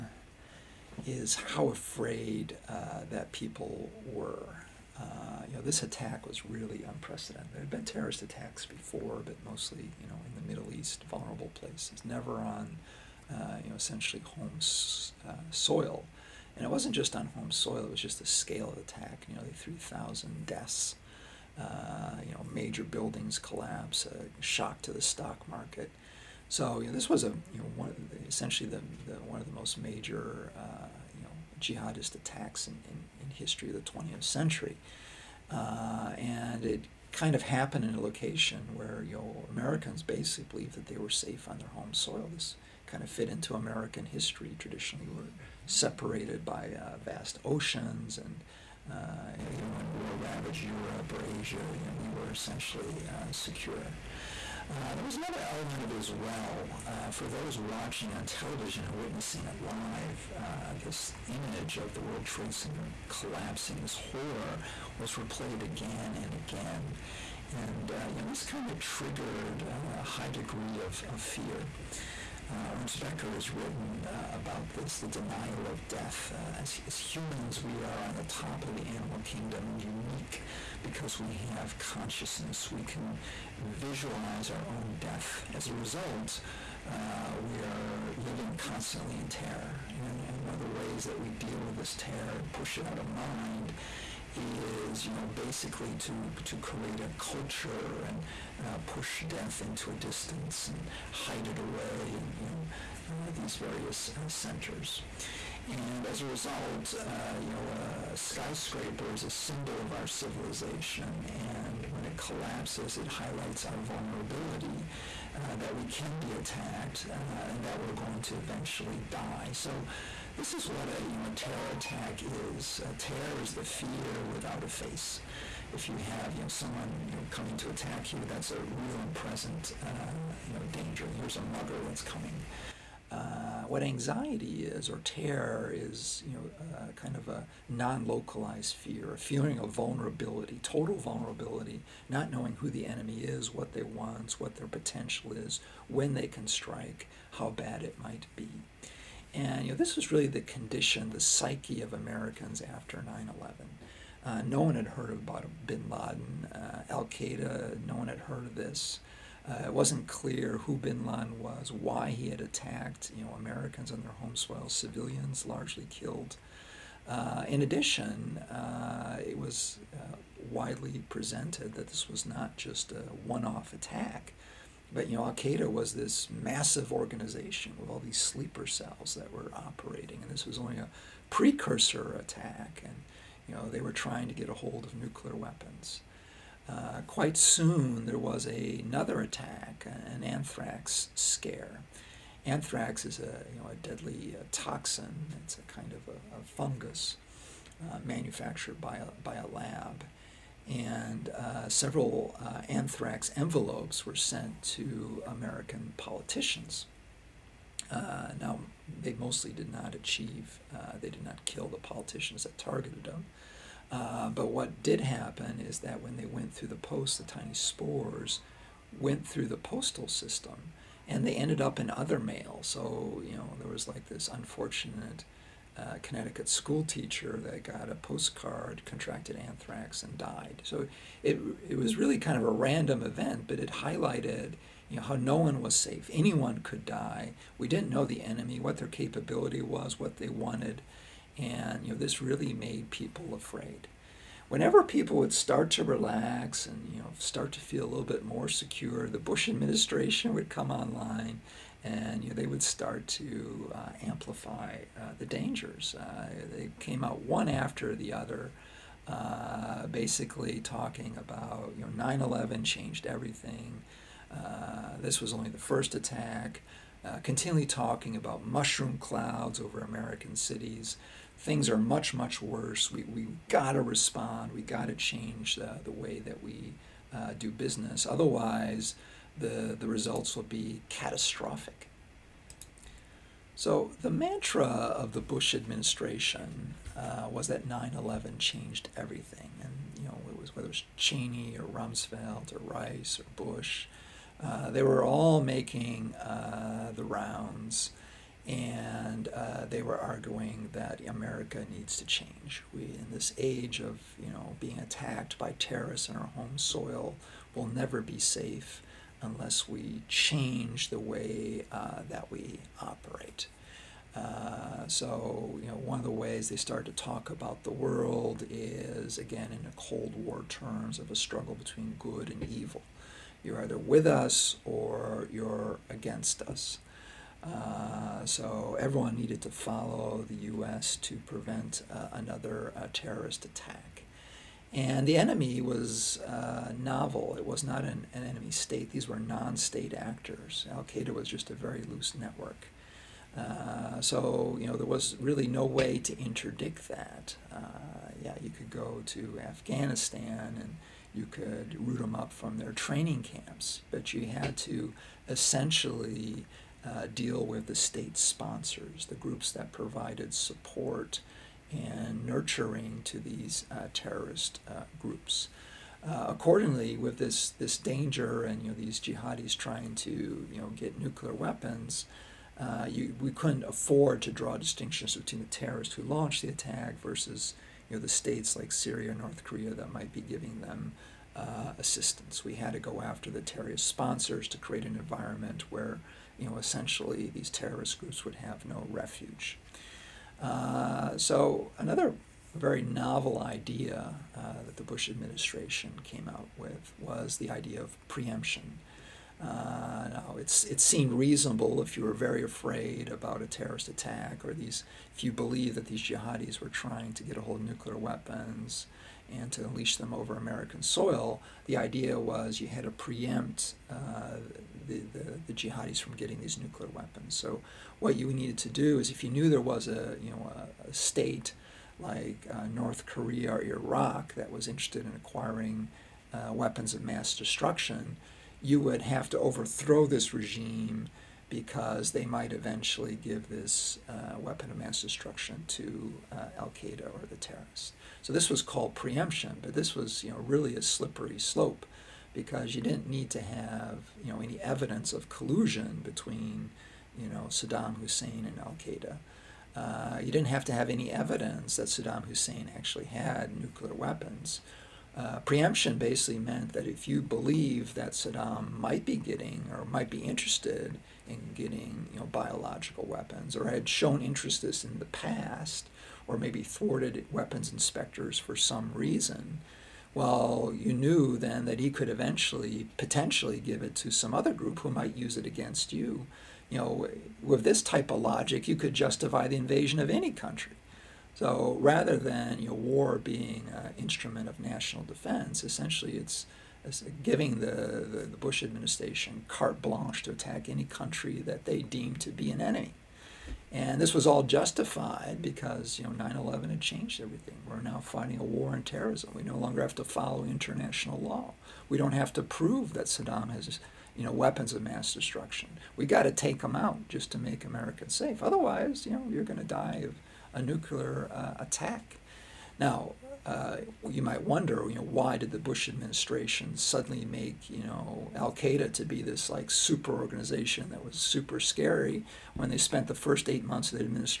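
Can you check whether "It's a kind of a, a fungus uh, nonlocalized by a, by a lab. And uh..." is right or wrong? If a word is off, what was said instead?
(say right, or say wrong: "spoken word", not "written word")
wrong: "manufactured", not "nonlocalized".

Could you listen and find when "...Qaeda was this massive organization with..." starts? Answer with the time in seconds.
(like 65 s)
175 s.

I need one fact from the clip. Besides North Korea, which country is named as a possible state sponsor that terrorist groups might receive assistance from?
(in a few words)
Syria.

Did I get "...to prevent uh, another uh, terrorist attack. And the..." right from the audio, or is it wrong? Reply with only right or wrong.
right.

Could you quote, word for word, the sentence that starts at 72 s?
Uh, Ernest Becker has written uh, about this the denial of death.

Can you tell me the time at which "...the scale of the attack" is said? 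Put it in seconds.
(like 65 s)
18 s.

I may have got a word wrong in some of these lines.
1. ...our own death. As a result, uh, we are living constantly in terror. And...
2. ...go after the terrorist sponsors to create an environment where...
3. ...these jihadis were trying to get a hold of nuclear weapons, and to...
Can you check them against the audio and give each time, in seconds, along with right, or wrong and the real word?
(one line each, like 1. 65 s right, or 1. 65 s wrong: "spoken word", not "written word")
1. 84 s right
2. 382 s right
3. 405 s right.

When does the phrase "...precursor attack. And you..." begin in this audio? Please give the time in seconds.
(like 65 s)
181 s.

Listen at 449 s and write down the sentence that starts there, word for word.
Uh, you didn't have to have any evidence that Saddam Hussein actually had nuclear weapons.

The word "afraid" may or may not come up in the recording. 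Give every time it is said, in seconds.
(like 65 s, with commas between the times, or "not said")
1 s, 243 s, 402 s.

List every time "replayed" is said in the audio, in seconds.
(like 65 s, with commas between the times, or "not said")
65 s.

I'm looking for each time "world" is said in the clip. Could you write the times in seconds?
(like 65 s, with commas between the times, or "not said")
62 s, 317 s.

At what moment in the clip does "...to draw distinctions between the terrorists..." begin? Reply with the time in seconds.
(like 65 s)
374 s.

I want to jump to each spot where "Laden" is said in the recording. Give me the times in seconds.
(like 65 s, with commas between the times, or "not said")
155 s, 161 s.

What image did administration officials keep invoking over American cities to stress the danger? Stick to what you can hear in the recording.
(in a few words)
Mushroom clouds.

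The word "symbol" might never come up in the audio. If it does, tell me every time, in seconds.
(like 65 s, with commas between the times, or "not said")
109 s.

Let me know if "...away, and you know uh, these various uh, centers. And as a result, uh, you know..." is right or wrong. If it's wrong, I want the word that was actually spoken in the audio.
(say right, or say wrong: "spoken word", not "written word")
right.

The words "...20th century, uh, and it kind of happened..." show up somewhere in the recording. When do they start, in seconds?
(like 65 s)
33 s.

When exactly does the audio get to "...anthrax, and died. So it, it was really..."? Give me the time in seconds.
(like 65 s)
229 s.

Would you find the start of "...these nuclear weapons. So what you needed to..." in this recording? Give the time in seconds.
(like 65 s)
416 s.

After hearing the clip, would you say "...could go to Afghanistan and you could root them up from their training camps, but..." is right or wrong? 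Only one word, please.
right.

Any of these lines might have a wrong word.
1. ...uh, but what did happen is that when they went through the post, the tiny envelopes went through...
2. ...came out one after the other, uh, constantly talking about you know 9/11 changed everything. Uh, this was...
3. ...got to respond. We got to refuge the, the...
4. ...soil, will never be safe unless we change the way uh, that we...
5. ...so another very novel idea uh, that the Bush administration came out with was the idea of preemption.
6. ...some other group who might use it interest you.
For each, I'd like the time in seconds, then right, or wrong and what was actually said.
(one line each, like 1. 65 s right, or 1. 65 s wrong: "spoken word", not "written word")
1. 213 s wrong: "spores", not "envelopes"
2. 256 s wrong: "basically", not "constantly"
3. 273 s wrong: "change", not "refuge"
4. 306 s right
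5. 391 s right
6. 474 s wrong: "against", not "interest".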